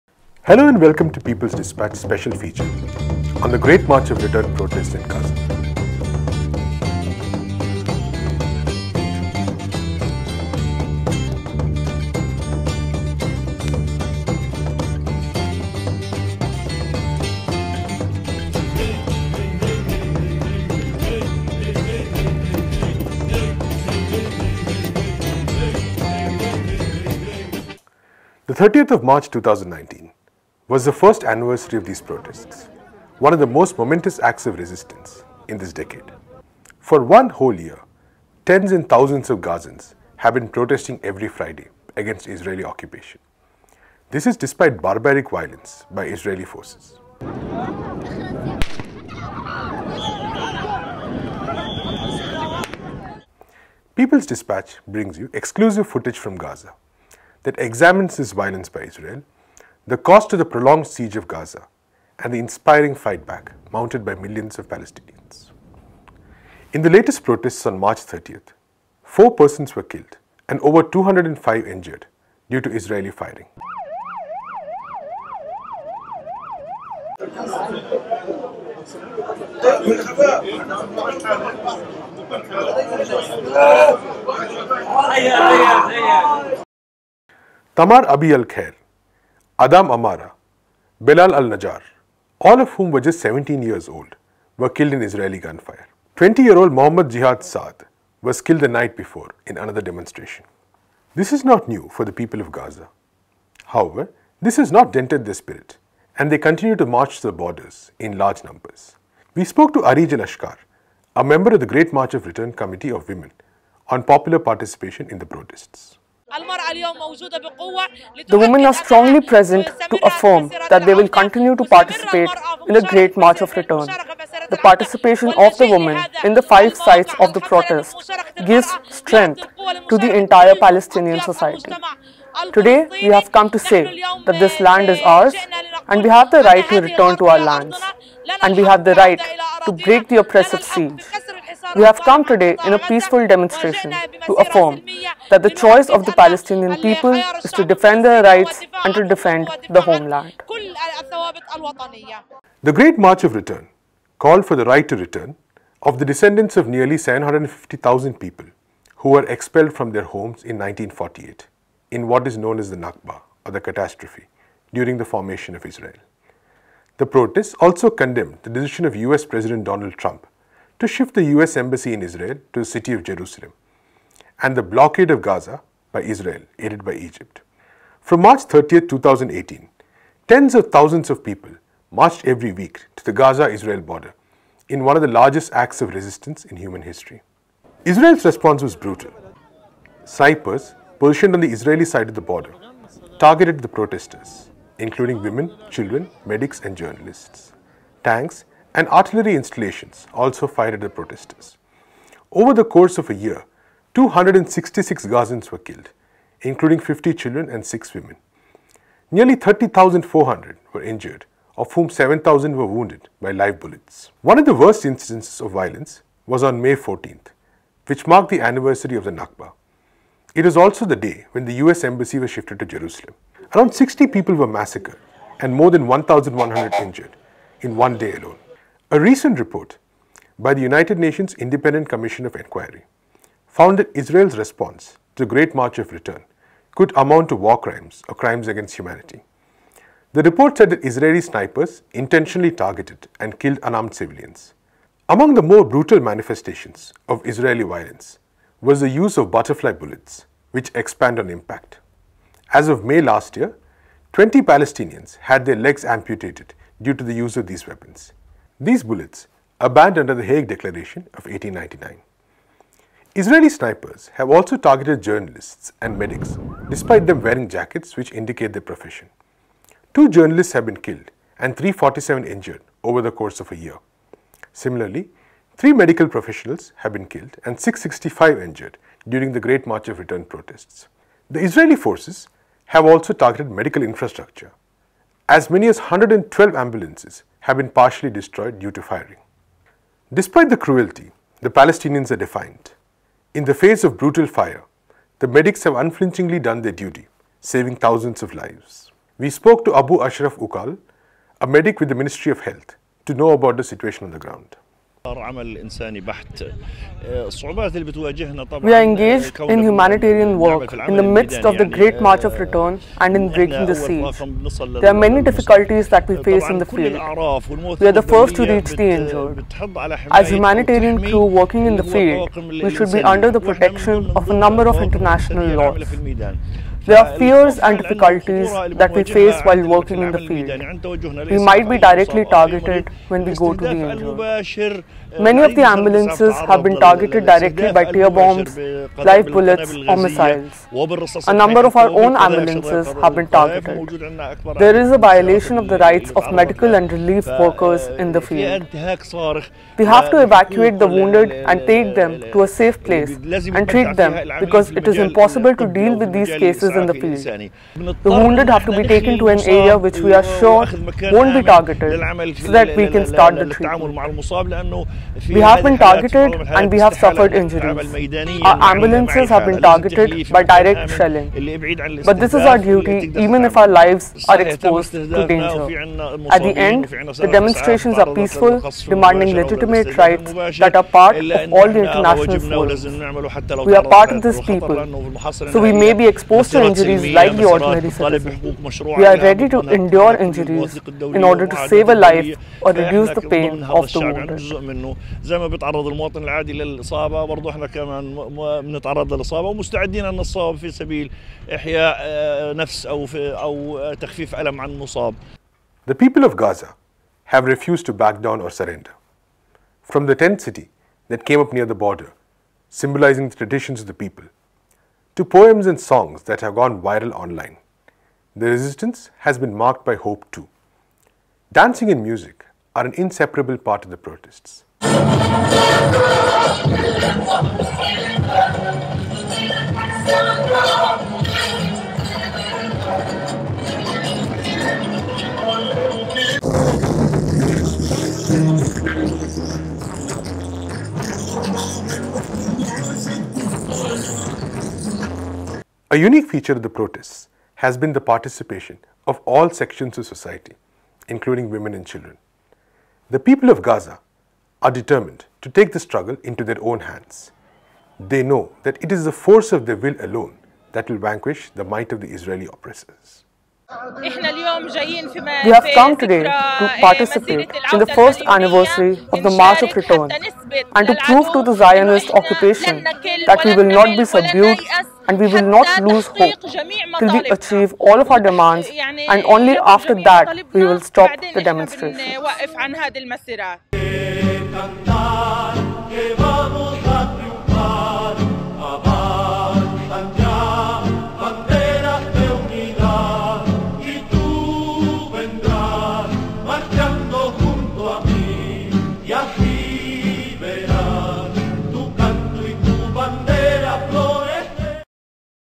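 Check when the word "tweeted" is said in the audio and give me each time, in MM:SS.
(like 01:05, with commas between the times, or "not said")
not said.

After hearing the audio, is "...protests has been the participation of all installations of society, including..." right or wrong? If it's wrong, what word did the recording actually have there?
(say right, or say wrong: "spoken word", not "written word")
wrong: "sections", not "installations".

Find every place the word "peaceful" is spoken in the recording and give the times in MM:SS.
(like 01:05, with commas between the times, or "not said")
02:22, 06:18.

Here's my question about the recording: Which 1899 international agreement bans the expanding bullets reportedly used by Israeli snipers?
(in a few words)
Hague Declaration.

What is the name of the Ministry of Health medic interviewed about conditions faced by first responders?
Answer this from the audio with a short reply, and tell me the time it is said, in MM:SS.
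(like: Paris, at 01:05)
Abu Ashraf Ukal, at 04:59.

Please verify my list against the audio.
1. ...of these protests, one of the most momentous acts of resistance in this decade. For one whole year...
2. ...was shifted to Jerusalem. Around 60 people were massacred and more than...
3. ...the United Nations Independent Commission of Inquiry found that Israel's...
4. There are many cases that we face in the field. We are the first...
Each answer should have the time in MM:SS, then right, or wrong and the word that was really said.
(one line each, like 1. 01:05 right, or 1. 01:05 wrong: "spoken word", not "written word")
1. 00:31 right
2. 03:42 right
3. 03:50 right
4. 05:14 wrong: "difficulties", not "cases".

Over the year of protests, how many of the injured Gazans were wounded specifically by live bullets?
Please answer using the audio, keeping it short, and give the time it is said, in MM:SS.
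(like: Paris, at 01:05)
7,000, at 03:31.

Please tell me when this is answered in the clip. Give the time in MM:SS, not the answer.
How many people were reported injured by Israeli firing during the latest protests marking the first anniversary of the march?
01:10.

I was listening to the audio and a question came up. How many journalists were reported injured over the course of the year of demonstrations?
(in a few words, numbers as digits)
347.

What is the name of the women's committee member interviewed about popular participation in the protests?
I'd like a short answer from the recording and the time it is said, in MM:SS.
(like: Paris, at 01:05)
Arij Al-Ashkar, at 01:49.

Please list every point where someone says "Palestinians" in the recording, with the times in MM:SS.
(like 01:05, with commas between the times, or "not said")
01:04, 02:10, 02:26, 04:14, 04:51.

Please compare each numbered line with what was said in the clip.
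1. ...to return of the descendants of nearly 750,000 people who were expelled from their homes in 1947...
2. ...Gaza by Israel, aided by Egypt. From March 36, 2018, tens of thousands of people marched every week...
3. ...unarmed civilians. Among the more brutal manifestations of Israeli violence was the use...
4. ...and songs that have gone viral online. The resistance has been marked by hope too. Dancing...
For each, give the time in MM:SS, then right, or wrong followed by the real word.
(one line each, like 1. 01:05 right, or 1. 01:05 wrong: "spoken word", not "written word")
1. 02:34 wrong: "1948", not "1947"
2. 02:55 wrong: "30", not "36"
3. 04:03 right
4. 06:55 right.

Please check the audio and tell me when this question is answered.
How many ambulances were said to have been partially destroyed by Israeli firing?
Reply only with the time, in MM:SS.
04:45.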